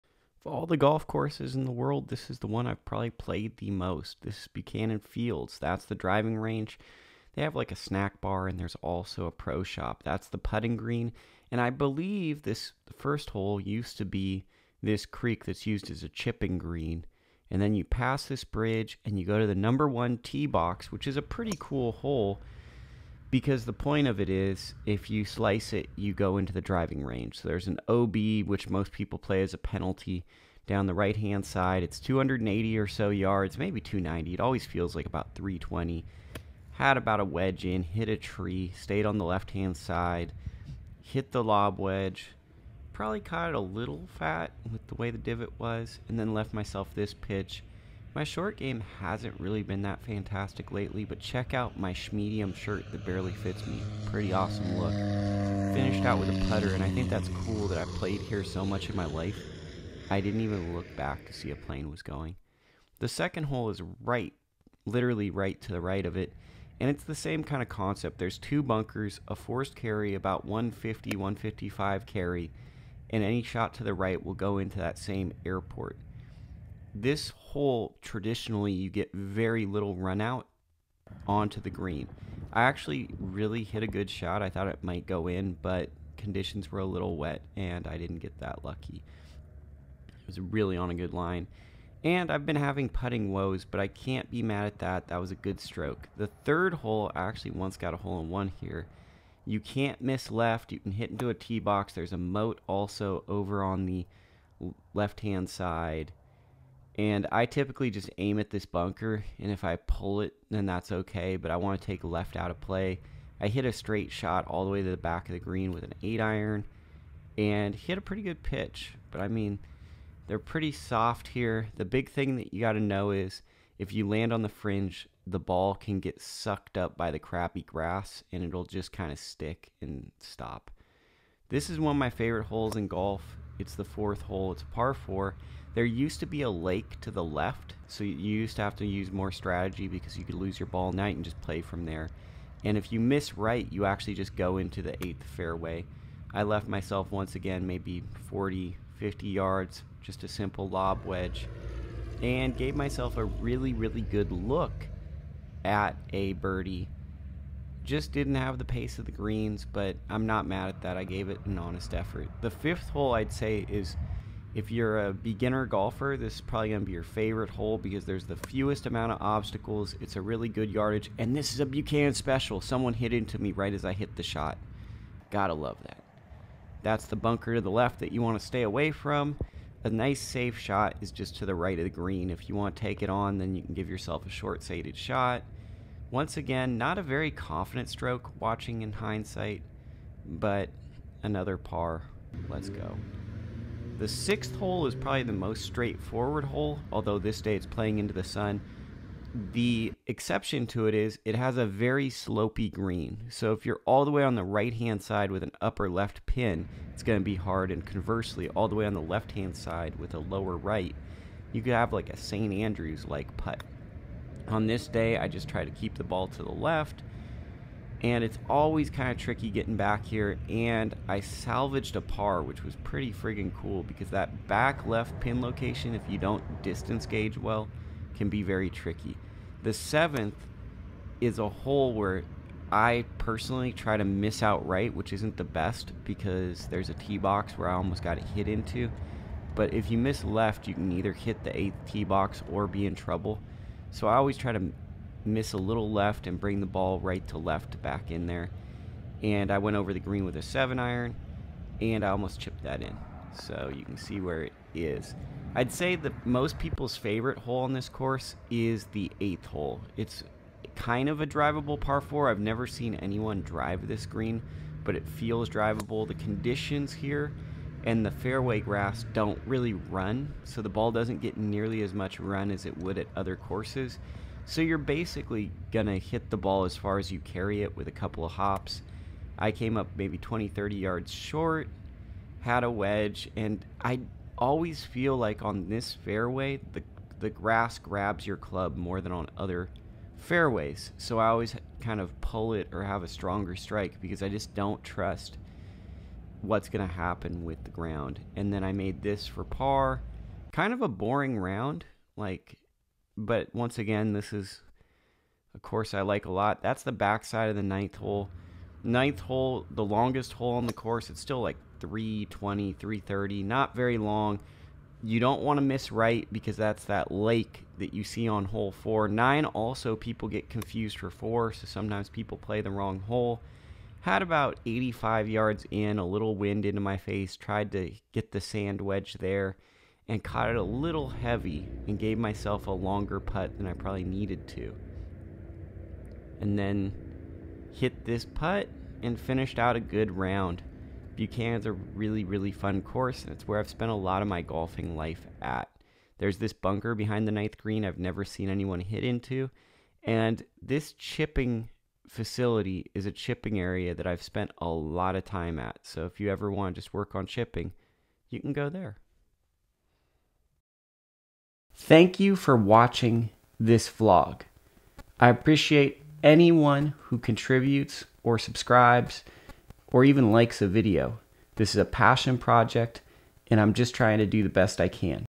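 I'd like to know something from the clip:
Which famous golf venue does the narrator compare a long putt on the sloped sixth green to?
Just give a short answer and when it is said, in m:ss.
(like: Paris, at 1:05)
St. Andrews, at 3:32.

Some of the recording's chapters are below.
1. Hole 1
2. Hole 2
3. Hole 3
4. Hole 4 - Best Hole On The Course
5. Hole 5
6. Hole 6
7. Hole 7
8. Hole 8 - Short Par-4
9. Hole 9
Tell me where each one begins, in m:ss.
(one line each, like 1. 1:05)
1. 0:15
2. 1:02
3. 1:35
4. 2:07
5. 2:45
6. 3:10
7. 3:44
8. 4:17
9. 5:01.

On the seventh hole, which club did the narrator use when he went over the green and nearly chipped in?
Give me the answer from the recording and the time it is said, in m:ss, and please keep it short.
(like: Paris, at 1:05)
seven iron, at 4:10.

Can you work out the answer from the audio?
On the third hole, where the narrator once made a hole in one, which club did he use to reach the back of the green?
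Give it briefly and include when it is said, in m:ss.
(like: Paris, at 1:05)
8 iron, at 1:56.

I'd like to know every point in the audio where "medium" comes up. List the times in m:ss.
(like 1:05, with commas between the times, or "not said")
0:52.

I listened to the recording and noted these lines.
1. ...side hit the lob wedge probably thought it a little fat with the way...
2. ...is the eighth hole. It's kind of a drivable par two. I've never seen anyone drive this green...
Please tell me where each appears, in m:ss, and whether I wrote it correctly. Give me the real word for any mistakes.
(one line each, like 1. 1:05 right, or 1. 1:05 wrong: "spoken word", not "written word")
1. 0:39 wrong: "caught", not "thought"
2. 4:18 wrong: "four", not "two".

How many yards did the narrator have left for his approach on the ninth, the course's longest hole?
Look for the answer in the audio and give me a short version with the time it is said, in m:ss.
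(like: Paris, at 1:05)
85 yards, at 5:24.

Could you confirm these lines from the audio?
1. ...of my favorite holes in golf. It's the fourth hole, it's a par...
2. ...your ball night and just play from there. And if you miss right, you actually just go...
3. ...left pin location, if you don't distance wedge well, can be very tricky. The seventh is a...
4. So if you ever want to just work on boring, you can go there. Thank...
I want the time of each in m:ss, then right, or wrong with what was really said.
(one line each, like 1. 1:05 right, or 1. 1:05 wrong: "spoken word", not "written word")
1. 2:11 right
2. 2:20 right
3. 3:44 wrong: "gauge", not "wedge"
4. 5:55 wrong: "chipping", not "boring".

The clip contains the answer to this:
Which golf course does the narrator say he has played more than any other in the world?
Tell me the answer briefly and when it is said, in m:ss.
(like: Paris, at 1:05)
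Buchanan Fields, at 0:04.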